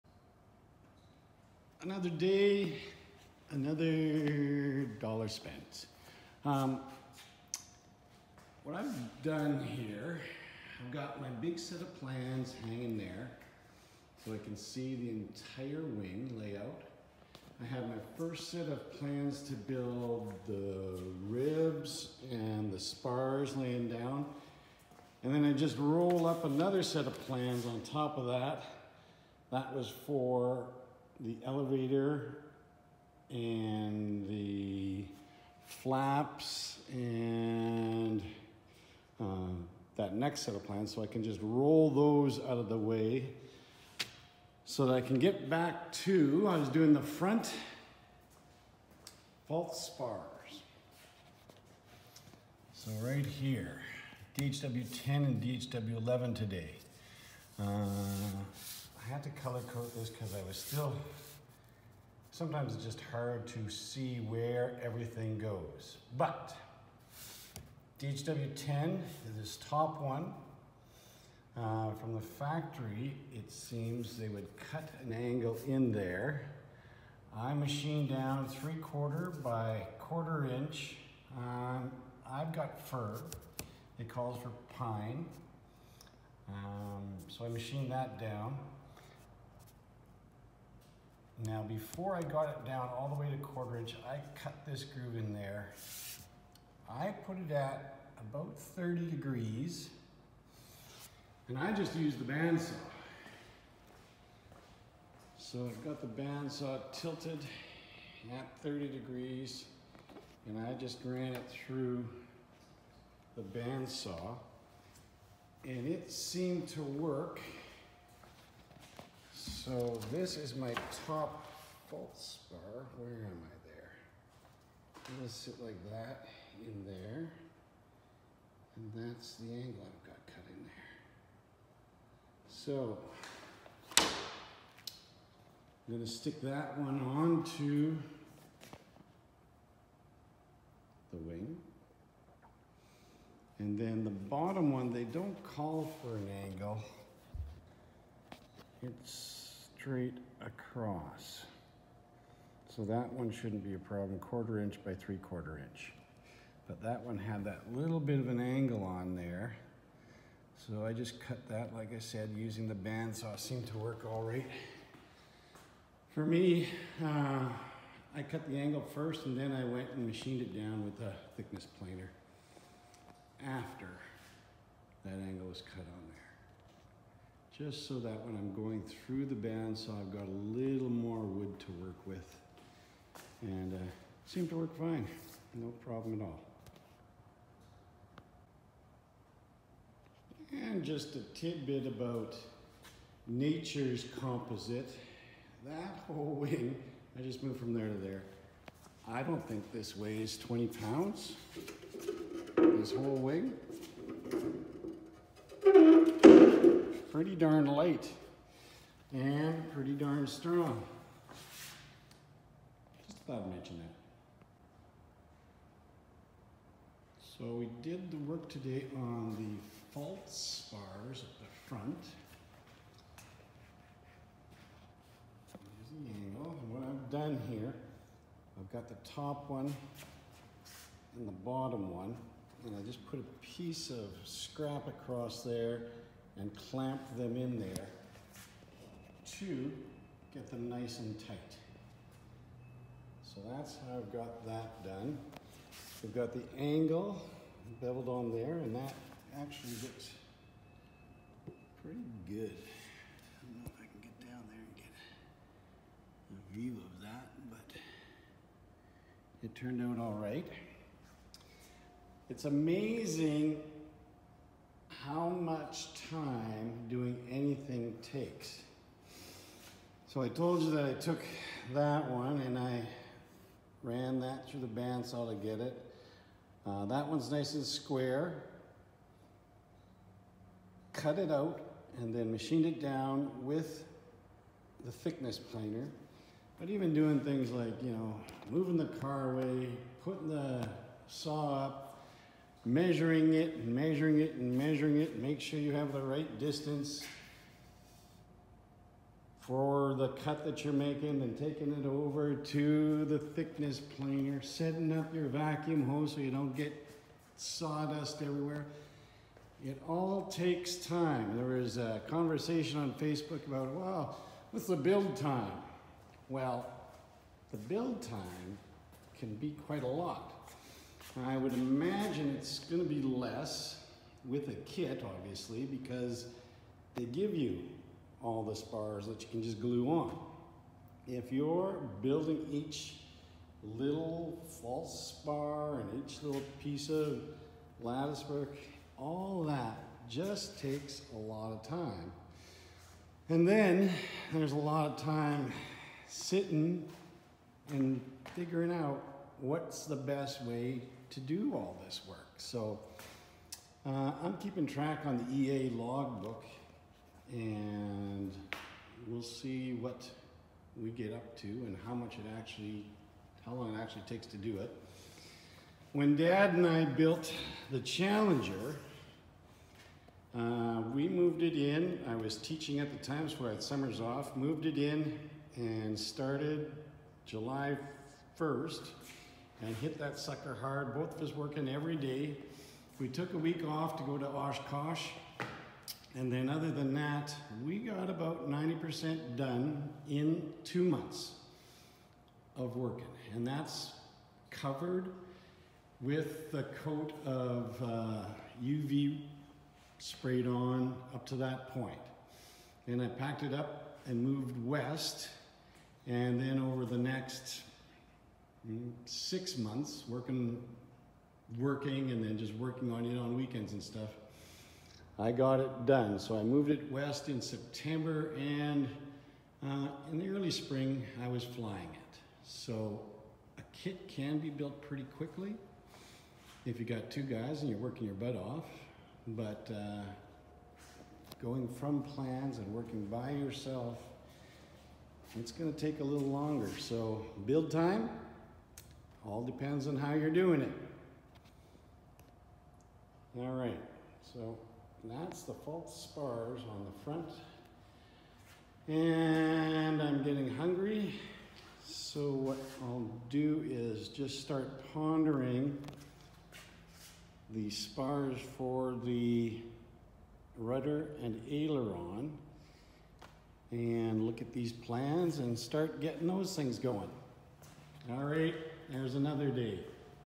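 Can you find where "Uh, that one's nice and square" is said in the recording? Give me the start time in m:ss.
4:36.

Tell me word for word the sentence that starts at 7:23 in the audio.
All right, so that's the false spars on the front.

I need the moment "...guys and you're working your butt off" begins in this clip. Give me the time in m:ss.
7:07.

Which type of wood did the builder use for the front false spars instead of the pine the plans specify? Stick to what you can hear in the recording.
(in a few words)
Fir.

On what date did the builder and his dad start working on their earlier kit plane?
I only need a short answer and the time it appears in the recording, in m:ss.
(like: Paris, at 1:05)
July 1, at 6:17.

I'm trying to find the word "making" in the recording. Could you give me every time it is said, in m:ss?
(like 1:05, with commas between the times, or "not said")
5:00.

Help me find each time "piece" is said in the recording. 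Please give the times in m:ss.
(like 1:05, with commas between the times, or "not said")
3:53, 5:36.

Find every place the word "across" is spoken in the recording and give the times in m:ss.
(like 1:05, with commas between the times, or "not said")
2:30, 3:54.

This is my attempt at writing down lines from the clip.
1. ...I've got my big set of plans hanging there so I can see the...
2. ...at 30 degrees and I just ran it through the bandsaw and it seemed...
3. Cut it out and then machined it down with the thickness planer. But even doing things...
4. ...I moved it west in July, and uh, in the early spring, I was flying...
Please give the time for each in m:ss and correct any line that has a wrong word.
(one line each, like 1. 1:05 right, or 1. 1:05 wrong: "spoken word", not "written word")
1. 0:10 right
2. 1:48 right
3. 4:40 right
4. 6:56 wrong: "September", not "July".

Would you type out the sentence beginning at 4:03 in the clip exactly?
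So that's how I've got that done.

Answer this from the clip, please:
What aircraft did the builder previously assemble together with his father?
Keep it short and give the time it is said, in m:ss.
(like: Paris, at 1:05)
Challenger, at 6:07.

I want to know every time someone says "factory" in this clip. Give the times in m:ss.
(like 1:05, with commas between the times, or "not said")
1:12.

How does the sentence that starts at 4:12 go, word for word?
I don't know if I can get down there and get a view of that, but it turned out all right.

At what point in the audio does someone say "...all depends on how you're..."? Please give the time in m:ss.
7:19.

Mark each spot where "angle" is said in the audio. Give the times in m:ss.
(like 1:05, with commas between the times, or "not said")
1:15, 2:09, 2:26, 2:38, 2:48, 2:55, 3:46, 4:06.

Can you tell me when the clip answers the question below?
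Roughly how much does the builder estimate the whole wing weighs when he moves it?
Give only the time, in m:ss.
3:20.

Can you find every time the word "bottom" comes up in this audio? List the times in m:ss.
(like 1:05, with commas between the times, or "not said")
2:24, 3:51.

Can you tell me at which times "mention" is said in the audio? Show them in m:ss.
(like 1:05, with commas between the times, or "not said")
3:33.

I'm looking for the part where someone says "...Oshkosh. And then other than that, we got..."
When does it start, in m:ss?
6:24.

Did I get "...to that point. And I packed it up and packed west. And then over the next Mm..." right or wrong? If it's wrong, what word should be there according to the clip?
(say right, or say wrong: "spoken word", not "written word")
wrong: "moved", not "packed".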